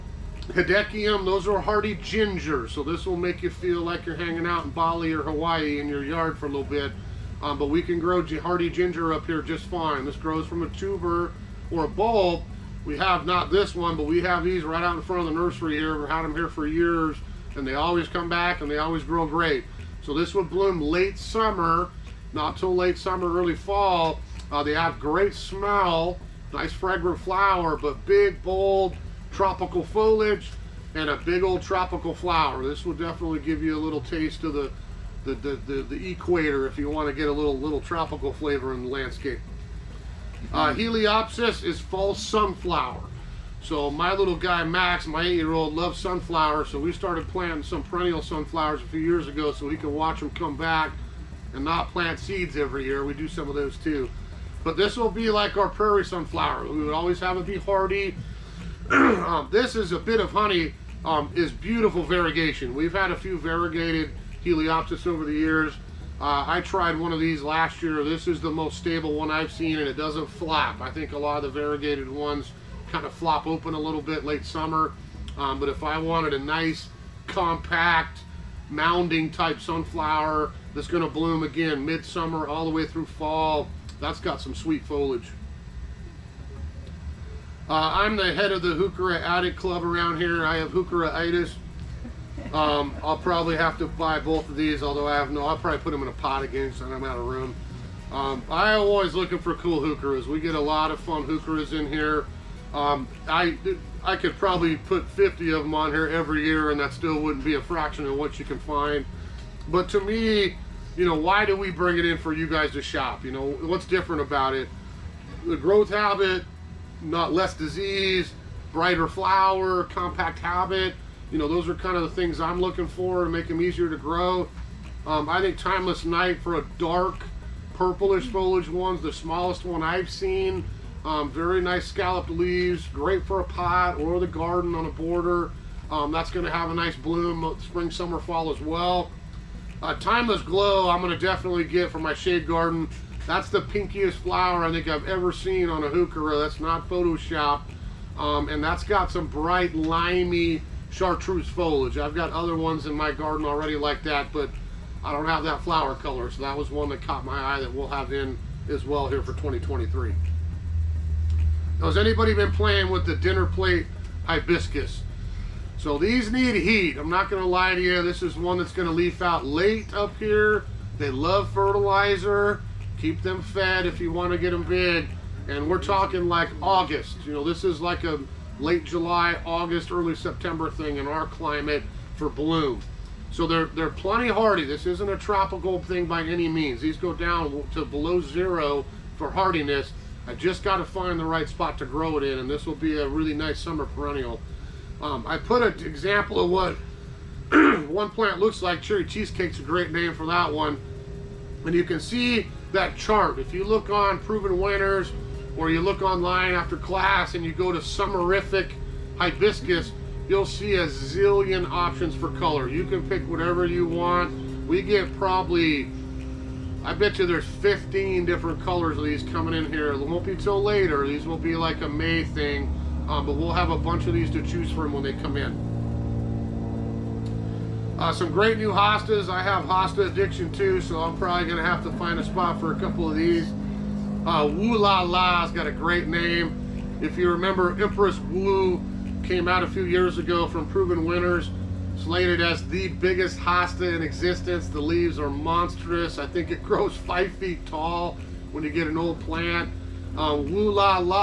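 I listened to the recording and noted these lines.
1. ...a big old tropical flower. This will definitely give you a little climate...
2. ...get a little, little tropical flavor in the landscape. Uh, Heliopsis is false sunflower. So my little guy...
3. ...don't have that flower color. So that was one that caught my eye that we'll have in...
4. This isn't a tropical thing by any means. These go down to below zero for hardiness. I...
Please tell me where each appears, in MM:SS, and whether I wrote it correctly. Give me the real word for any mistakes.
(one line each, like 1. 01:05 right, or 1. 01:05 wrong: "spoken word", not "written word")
1. 00:31 wrong: "taste", not "climate"
2. 00:37 right
3. 02:35 right
4. 03:04 right.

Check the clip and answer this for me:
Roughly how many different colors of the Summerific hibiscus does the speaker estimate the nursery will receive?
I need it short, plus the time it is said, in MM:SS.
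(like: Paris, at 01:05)
15, at 03:37.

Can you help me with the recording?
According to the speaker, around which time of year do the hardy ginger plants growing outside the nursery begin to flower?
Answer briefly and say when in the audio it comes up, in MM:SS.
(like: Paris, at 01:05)
late summer, early fall, at 00:22.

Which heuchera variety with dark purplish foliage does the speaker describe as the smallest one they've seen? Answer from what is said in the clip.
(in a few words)
Timeless Night.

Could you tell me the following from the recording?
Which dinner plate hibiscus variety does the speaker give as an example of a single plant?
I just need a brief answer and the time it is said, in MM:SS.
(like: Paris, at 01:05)
Cherry Cheesecake, at 03:18.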